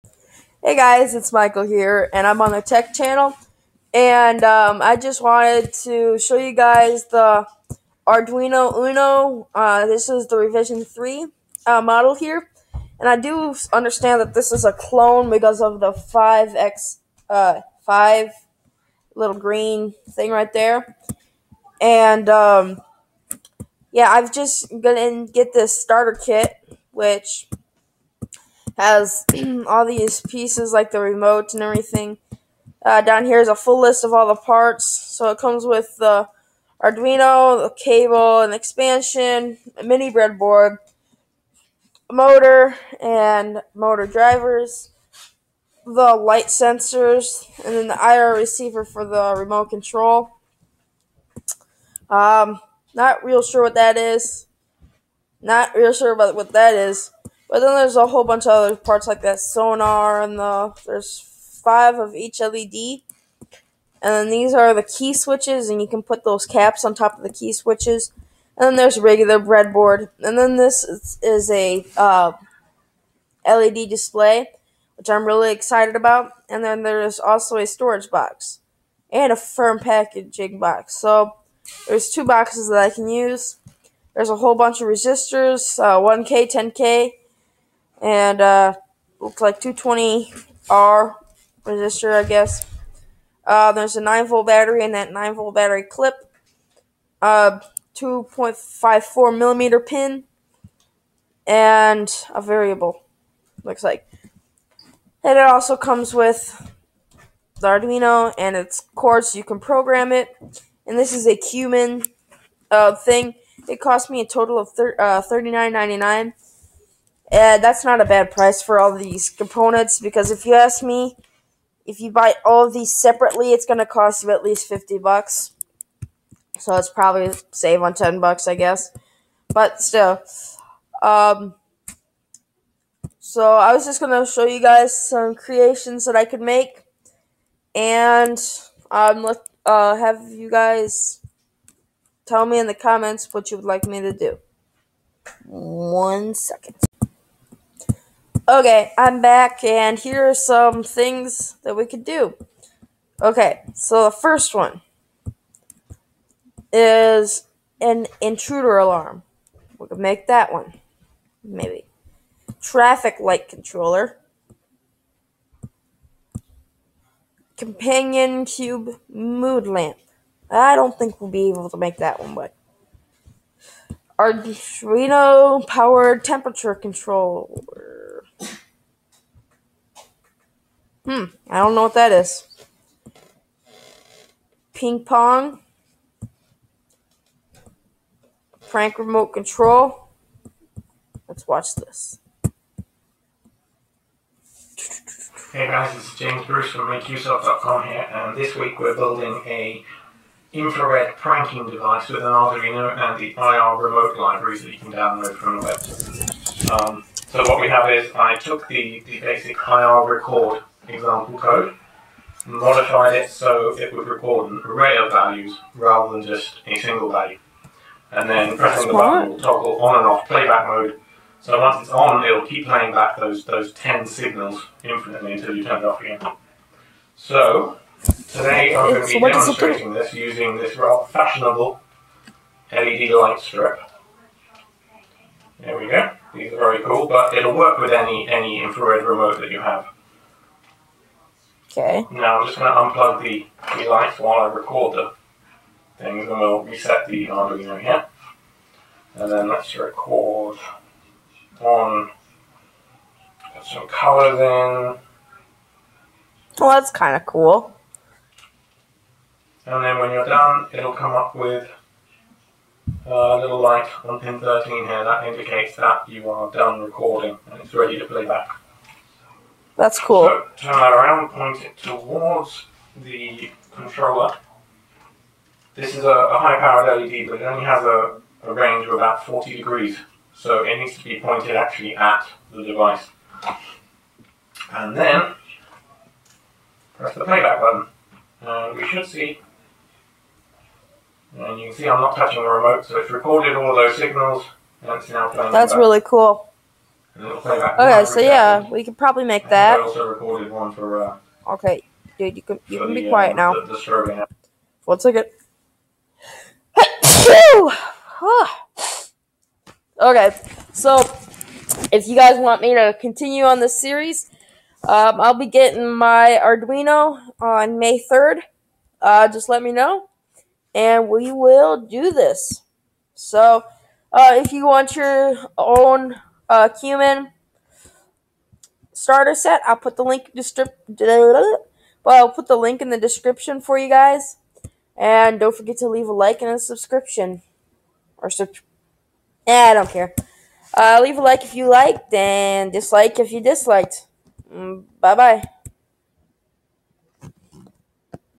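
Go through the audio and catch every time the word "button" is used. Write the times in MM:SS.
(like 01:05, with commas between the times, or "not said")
03:38, 04:47.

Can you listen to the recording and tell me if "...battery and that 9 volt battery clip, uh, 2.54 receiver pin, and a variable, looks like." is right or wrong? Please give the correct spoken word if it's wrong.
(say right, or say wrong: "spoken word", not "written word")
wrong: "millimeter", not "receiver".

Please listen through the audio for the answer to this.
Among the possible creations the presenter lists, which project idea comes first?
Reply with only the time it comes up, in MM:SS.
02:38.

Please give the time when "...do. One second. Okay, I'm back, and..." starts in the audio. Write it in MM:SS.
02:24.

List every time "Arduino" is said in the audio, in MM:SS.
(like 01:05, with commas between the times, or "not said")
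00:08, 00:36, 01:47, 02:54, 03:22, 04:07, 05:16.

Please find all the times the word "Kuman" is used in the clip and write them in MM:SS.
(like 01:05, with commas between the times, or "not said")
01:51, 05:26.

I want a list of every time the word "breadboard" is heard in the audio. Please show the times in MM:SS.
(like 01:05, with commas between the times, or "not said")
00:40, 01:09.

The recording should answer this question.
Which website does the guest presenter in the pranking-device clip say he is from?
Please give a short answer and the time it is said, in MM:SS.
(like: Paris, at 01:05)
MakeUseOf.com, at 03:16.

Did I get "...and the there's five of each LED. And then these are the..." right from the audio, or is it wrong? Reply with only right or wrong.
right.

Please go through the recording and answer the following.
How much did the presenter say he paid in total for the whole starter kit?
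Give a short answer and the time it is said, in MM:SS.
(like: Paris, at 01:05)
$39.99, at 01:55.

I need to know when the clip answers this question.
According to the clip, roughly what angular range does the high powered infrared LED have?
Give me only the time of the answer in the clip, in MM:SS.
04:39.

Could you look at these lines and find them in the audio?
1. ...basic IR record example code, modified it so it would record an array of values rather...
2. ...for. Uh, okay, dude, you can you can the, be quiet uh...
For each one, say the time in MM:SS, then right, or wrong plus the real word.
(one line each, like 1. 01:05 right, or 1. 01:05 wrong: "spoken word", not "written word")
1. 03:29 right
2. 05:00 right.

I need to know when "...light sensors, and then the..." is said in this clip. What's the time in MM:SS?
00:46.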